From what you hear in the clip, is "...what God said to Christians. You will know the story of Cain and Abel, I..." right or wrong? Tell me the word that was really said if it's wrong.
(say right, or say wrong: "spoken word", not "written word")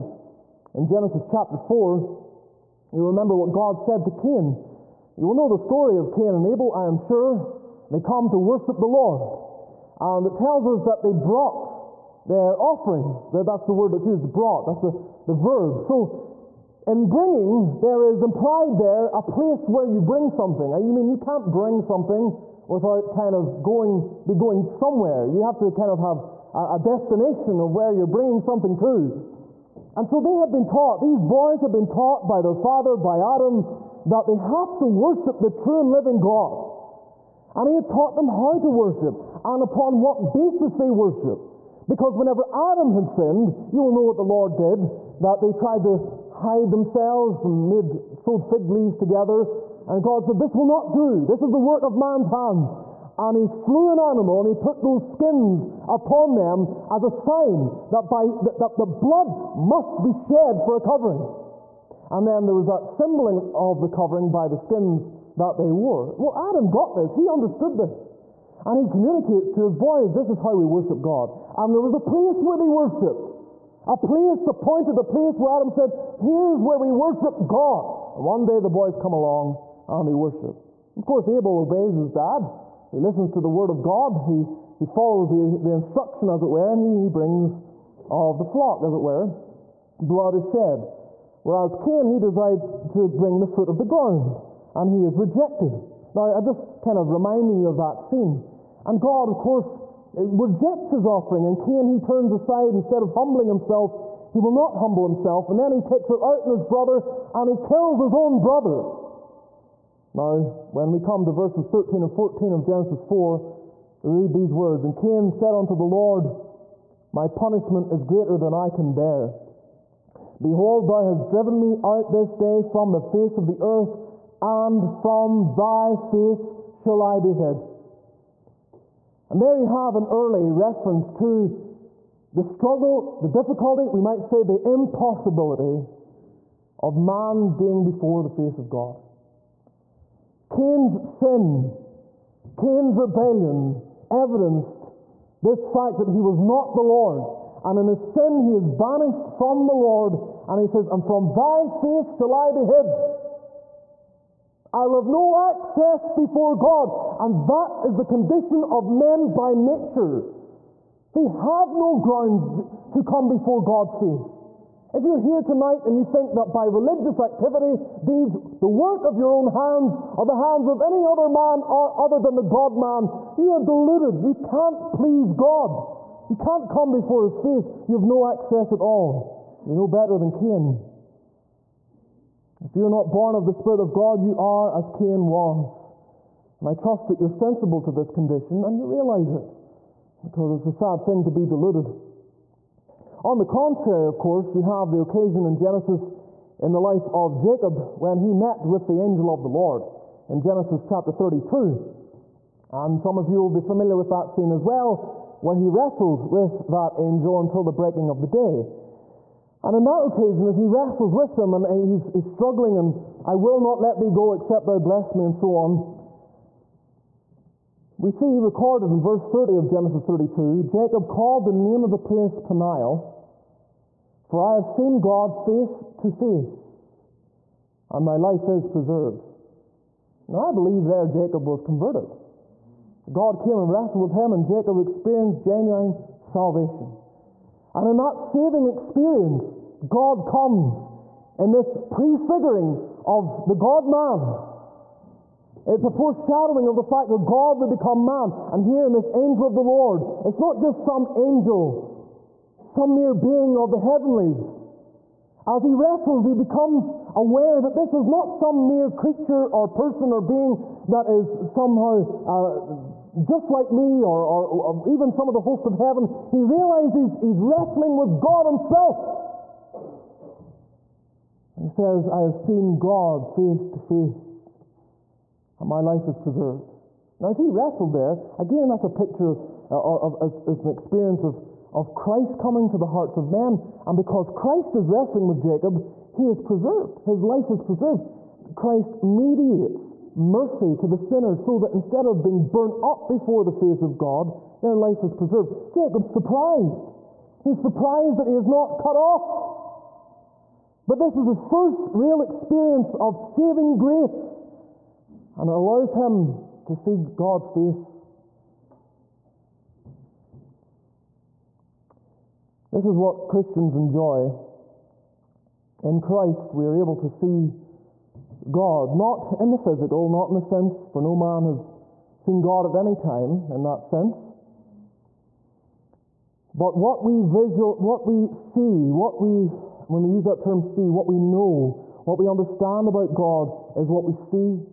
wrong: "Cain", not "Christians".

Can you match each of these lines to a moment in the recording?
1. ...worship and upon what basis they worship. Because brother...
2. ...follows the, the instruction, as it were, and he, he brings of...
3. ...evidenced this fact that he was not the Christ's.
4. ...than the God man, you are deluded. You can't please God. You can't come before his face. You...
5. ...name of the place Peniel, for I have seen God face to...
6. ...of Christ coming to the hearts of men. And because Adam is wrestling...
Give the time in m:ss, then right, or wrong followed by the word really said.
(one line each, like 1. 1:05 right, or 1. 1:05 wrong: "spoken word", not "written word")
1. 0:38 wrong: "whenever", not "brother"
2. 1:24 right
3. 2:24 wrong: "Lord", not "Christ"
4. 2:52 right
5. 3:41 right
6. 4:41 wrong: "Christ", not "Adam".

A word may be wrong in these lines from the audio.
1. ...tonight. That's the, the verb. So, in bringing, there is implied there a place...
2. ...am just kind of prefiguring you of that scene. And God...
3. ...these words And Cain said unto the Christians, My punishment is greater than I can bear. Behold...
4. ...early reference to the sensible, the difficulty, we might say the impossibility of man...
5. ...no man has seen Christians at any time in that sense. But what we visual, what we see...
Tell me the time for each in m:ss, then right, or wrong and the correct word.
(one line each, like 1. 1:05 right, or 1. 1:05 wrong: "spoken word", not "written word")
1. 0:14 wrong: "brought", not "tonight"
2. 1:36 wrong: "reminding", not "prefiguring"
3. 1:54 wrong: "Lord", not "Christians"
4. 2:10 wrong: "struggle", not "sensible"
5. 5:20 wrong: "God", not "Christians".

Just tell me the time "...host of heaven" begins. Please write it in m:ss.
4:25.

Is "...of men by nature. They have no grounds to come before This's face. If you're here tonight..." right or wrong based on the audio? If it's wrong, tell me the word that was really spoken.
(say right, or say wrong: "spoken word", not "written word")
wrong: "God", not "This".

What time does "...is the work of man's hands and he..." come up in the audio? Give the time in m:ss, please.
0:51.